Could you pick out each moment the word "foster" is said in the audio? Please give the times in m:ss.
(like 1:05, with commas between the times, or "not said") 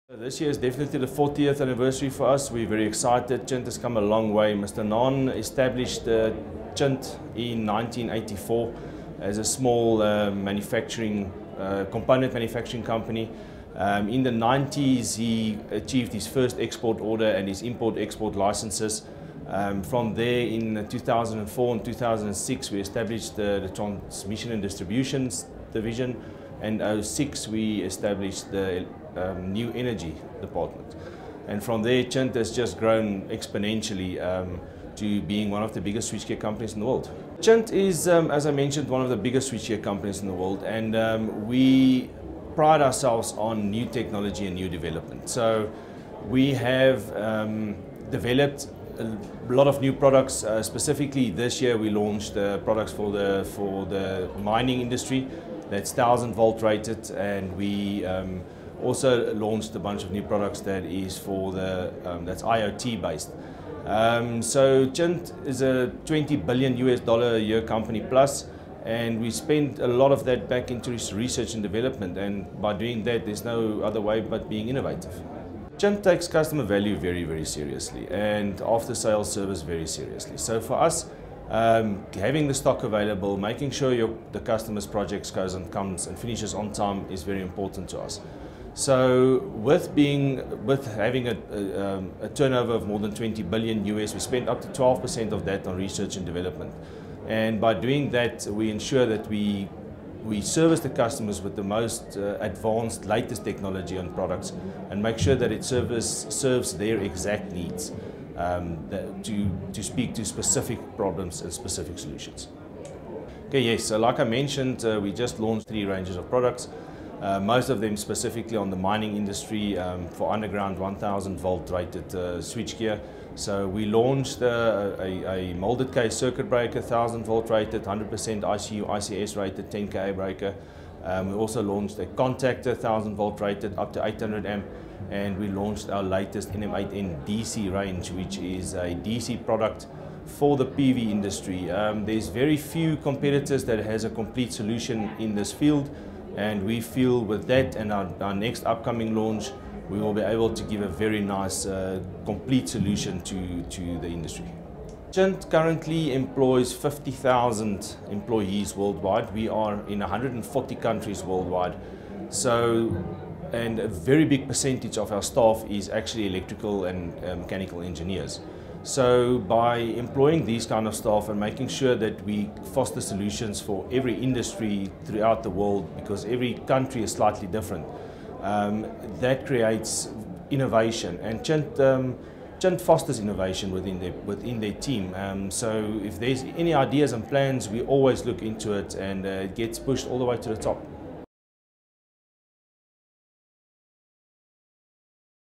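2:52, 3:02.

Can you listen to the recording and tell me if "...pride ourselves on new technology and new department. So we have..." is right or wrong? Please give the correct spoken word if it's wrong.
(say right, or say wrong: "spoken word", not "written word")
wrong: "development", not "department".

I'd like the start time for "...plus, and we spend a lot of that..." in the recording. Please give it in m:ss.
1:08.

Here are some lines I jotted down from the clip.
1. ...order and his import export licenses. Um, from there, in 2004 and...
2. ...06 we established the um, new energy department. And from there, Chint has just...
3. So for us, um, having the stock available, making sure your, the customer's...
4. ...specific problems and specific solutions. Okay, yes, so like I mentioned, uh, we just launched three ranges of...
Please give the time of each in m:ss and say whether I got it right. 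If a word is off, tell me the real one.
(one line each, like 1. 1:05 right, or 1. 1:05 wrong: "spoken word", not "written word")
1. 0:16 right
2. 0:27 right
3. 1:20 right
4. 1:50 right.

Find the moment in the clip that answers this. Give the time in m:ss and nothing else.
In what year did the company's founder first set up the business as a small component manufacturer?
0:07.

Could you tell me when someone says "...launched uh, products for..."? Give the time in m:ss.
0:51.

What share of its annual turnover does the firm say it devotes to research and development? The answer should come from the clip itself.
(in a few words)
12%.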